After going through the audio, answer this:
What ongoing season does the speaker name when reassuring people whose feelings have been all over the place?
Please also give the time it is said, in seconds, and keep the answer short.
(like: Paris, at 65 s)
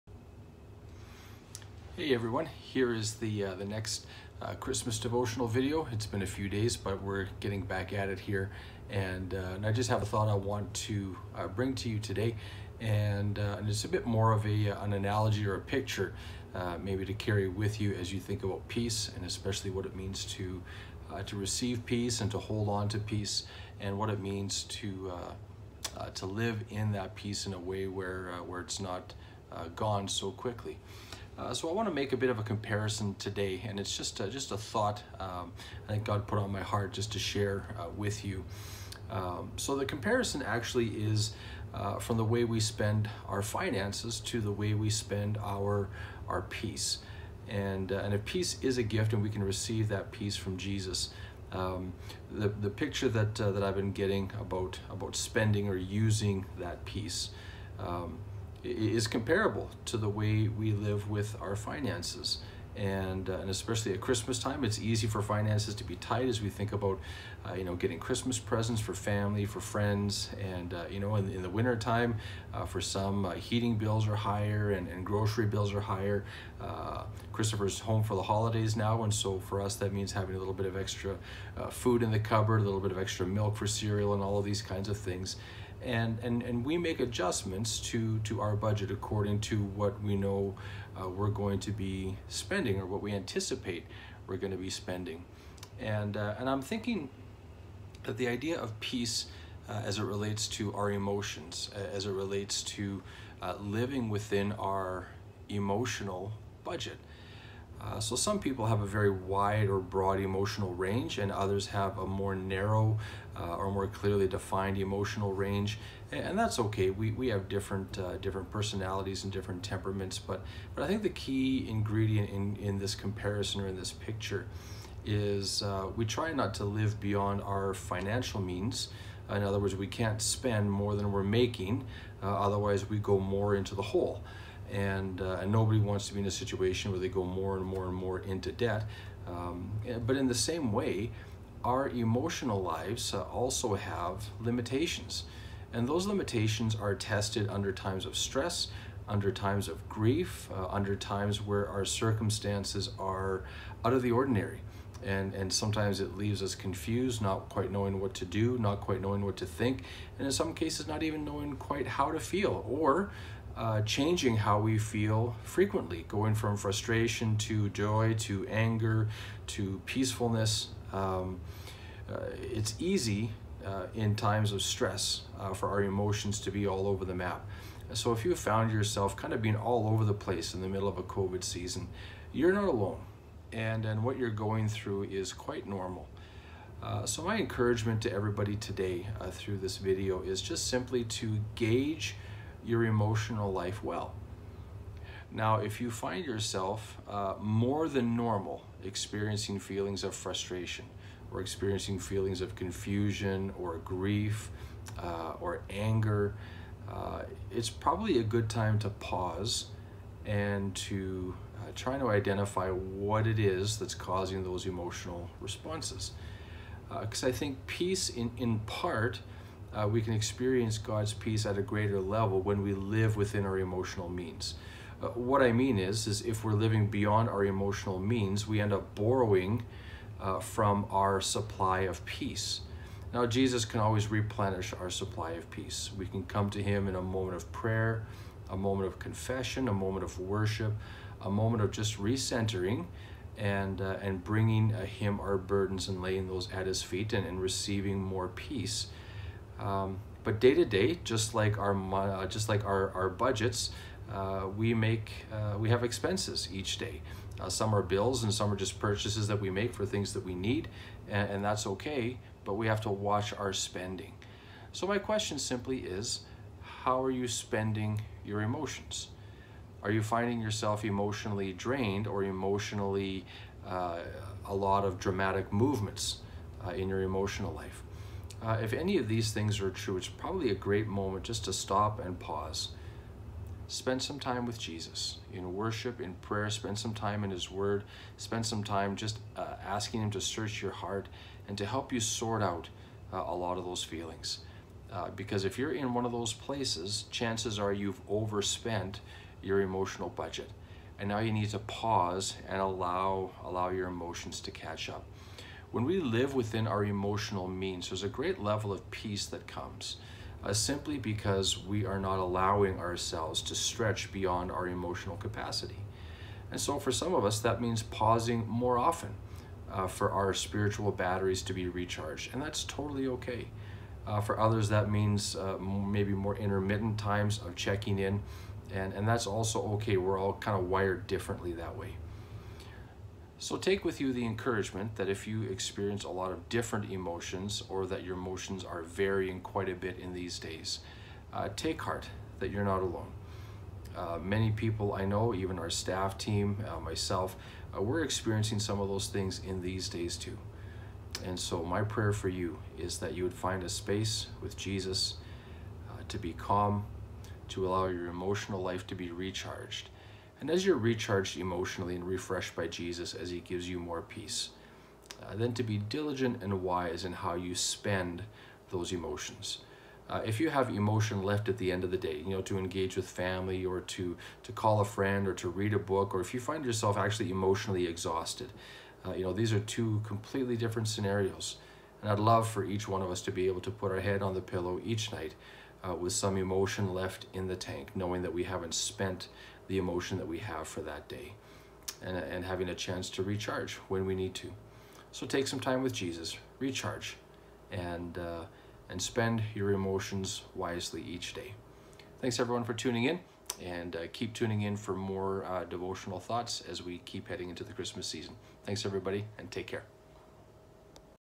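COVID season, at 181 s.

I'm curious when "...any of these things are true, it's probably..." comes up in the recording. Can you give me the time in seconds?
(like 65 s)
278 s.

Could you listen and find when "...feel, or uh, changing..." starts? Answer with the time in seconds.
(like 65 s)
162 s.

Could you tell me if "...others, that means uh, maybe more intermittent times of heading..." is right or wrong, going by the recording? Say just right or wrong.
wrong.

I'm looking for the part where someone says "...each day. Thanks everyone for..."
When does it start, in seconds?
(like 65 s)
401 s.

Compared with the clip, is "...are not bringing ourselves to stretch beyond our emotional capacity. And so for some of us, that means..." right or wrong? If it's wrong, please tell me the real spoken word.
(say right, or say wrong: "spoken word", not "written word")
wrong: "allowing", not "bringing".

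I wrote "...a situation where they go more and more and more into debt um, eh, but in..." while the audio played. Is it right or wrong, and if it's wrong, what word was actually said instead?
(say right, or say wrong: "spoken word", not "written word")
right.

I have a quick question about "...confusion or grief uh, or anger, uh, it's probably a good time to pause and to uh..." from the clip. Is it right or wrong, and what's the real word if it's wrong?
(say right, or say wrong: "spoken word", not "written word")
right.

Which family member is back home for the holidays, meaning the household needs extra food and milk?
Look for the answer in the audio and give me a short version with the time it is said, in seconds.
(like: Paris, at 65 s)
Christopher, at 77 s.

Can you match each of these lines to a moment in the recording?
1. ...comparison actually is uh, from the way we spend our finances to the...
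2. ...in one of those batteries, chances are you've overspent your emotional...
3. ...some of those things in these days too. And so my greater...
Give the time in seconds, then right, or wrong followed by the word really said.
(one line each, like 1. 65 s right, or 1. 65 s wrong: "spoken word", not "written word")
1. 39 s right
2. 295 s wrong: "places", not "batteries"
3. 348 s wrong: "prayer", not "greater".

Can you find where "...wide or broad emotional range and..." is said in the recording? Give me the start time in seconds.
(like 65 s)
109 s.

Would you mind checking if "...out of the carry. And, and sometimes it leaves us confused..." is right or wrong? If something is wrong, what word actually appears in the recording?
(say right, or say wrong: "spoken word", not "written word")
wrong: "ordinary", not "carry".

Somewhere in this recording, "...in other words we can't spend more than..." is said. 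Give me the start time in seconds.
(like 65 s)
129 s.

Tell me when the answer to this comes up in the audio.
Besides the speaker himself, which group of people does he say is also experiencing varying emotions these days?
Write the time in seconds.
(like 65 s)
345 s.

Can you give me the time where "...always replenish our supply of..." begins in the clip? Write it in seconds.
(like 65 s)
233 s.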